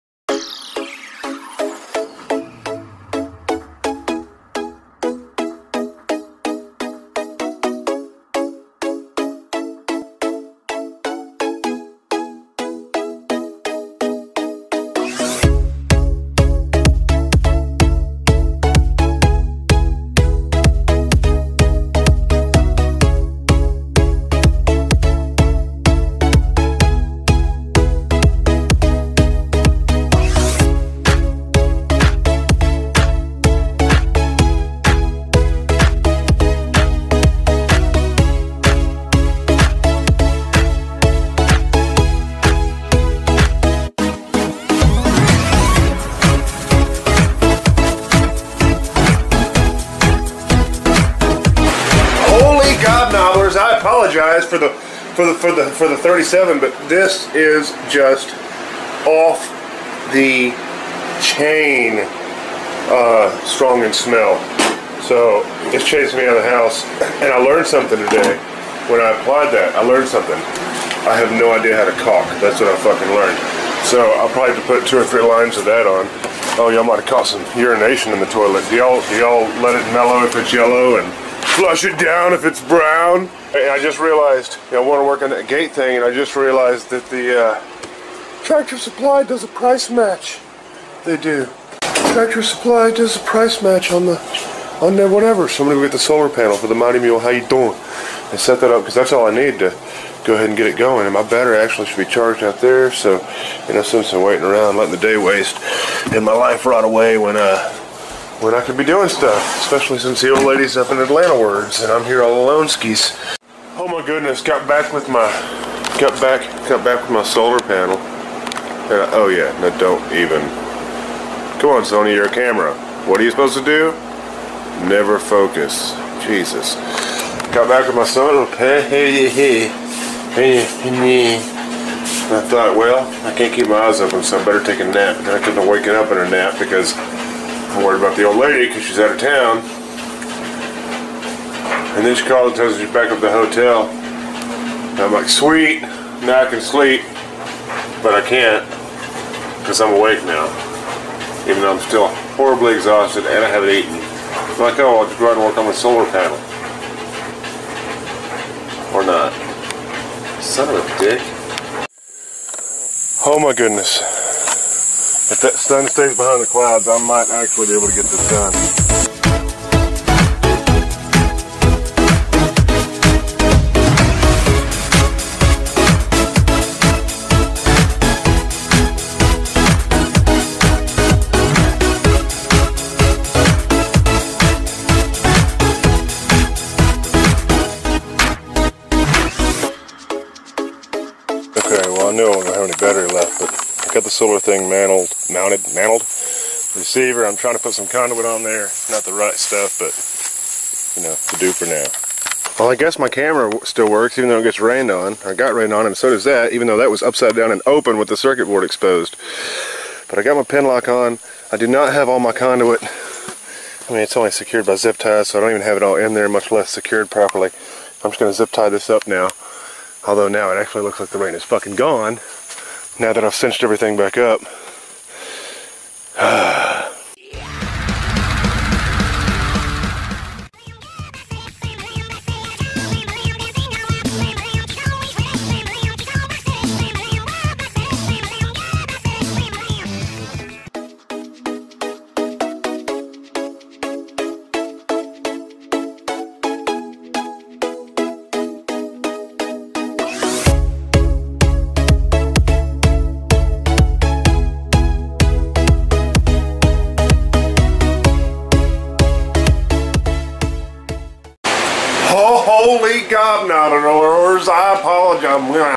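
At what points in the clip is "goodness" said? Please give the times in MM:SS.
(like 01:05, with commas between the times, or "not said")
01:54, 02:43.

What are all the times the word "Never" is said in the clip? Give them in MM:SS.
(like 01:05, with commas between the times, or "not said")
02:04.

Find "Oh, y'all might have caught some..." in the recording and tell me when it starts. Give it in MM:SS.
01:16.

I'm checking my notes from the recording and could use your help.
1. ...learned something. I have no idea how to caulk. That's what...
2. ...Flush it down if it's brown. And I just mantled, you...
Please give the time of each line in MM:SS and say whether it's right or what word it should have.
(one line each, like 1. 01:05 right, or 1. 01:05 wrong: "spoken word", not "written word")
1. 01:09 right
2. 01:21 wrong: "realized", not "mantled".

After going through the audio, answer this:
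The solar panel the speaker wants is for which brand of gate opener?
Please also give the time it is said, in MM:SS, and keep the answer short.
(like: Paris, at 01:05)
Mighty Mule, at 01:36.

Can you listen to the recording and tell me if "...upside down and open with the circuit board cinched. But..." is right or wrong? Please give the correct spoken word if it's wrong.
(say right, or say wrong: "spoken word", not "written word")
wrong: "exposed", not "cinched".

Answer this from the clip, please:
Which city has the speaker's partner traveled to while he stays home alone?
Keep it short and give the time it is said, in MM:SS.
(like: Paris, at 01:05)
Atlanta, at 01:50.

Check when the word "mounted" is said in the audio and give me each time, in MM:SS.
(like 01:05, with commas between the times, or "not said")
03:15.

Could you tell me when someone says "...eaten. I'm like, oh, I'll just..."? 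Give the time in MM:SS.
02:33.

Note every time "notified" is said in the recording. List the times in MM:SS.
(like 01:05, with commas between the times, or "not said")
not said.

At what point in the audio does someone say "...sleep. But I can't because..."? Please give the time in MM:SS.
02:26.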